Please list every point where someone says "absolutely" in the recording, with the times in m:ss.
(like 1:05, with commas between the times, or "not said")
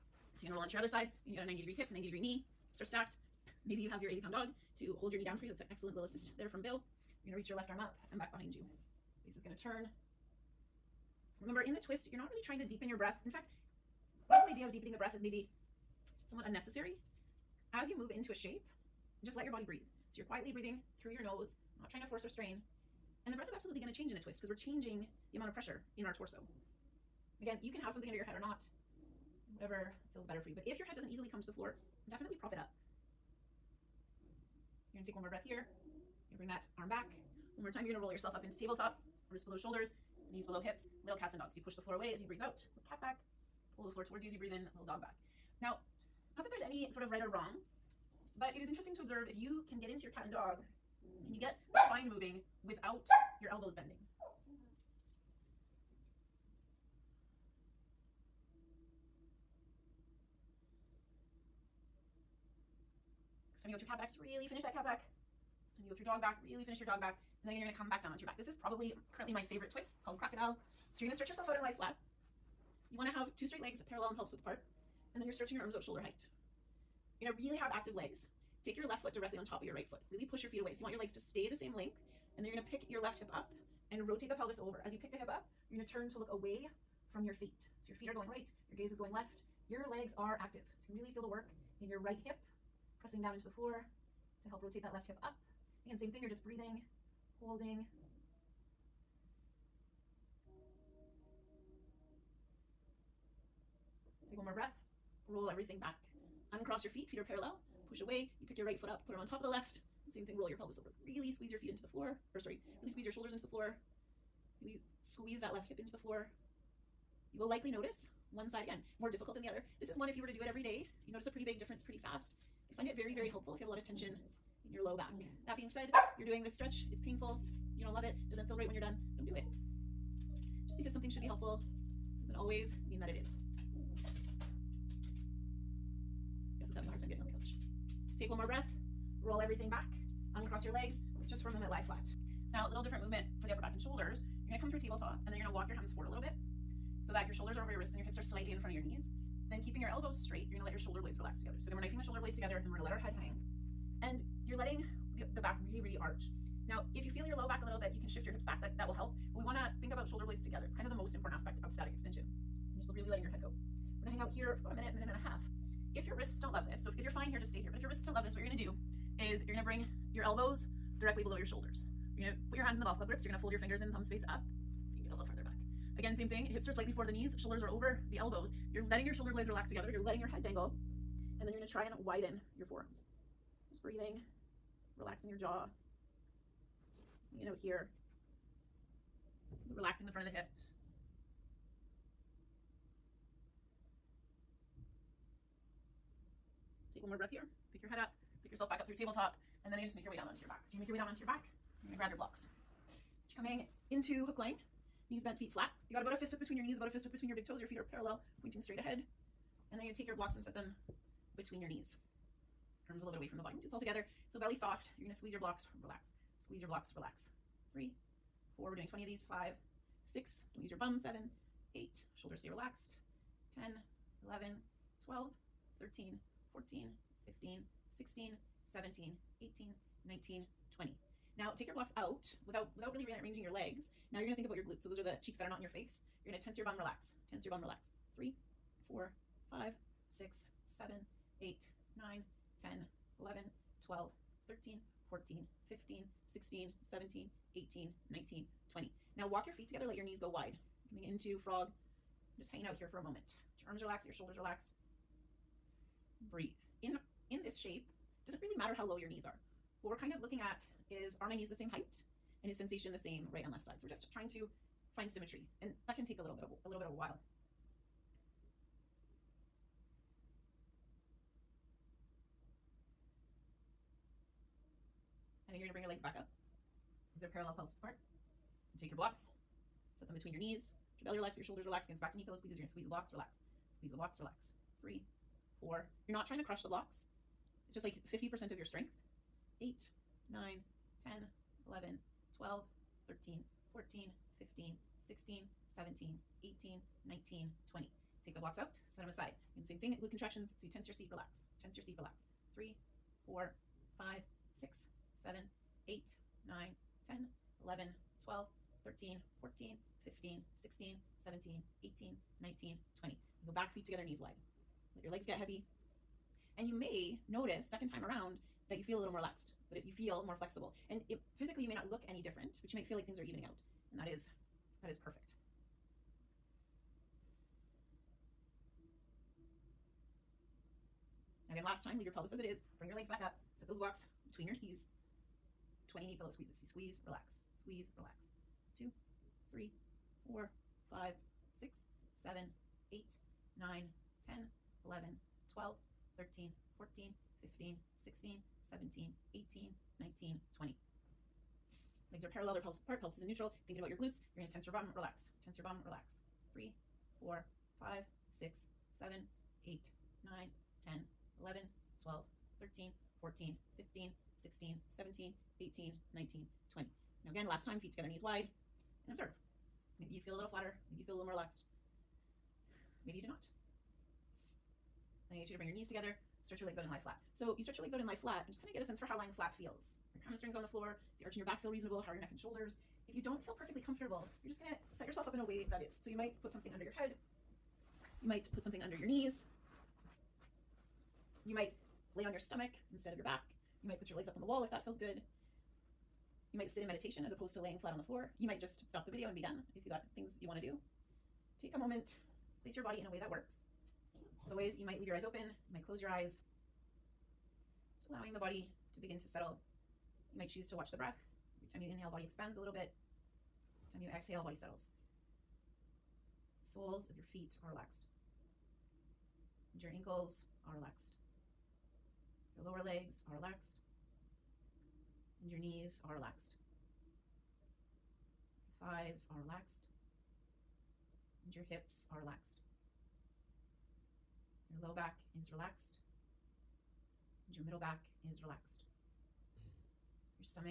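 0:23.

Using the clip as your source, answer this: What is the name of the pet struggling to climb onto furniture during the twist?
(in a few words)
Gus.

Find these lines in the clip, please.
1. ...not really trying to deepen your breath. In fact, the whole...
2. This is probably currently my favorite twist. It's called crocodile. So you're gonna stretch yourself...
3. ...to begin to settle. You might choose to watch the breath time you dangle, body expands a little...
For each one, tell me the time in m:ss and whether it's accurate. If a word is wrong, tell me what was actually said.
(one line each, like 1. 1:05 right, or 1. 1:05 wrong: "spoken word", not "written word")
1. 0:12 right
2. 1:08 right
3. 6:48 wrong: "inhale", not "dangle".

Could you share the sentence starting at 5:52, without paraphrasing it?
Legs are parallel, they're pelvis apart, pelvis is in neutral.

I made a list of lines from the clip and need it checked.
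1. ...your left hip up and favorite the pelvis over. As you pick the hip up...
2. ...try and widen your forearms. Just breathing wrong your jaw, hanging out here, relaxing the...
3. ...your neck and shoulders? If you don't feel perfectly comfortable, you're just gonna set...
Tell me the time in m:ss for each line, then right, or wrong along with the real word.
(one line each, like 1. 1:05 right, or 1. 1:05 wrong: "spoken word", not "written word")
1. 1:22 wrong: "rotate", not "favorite"
2. 3:01 wrong: "relaxing", not "wrong"
3. 6:22 right.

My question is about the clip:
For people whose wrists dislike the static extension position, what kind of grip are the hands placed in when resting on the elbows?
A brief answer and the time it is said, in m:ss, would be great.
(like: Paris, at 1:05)
Golf club grips, at 2:52.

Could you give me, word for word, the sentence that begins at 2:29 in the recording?
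Then keeping your elbows straight, you're gonna let your shoulder blades relax together.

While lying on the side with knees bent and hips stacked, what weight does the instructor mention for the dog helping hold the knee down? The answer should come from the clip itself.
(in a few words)
80 pounds.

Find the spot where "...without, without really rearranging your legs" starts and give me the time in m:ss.
3:52.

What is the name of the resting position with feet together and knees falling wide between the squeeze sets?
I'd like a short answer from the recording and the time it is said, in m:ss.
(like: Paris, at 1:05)
Frog, at 4:11.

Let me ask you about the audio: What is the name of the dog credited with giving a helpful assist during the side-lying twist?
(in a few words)
Bill.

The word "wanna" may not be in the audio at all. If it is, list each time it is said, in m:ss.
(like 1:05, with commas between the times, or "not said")
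1:12, 2:39.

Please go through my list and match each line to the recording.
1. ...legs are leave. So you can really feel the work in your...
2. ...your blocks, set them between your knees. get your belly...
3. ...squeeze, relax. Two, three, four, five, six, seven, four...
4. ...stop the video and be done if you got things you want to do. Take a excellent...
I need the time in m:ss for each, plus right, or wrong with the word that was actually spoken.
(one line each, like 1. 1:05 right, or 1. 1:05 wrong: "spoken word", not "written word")
1. 1:29 wrong: "active", not "leave"
2. 4:38 right
3. 5:37 wrong: "eight", not "four"
4. 6:38 wrong: "moment", not "excellent".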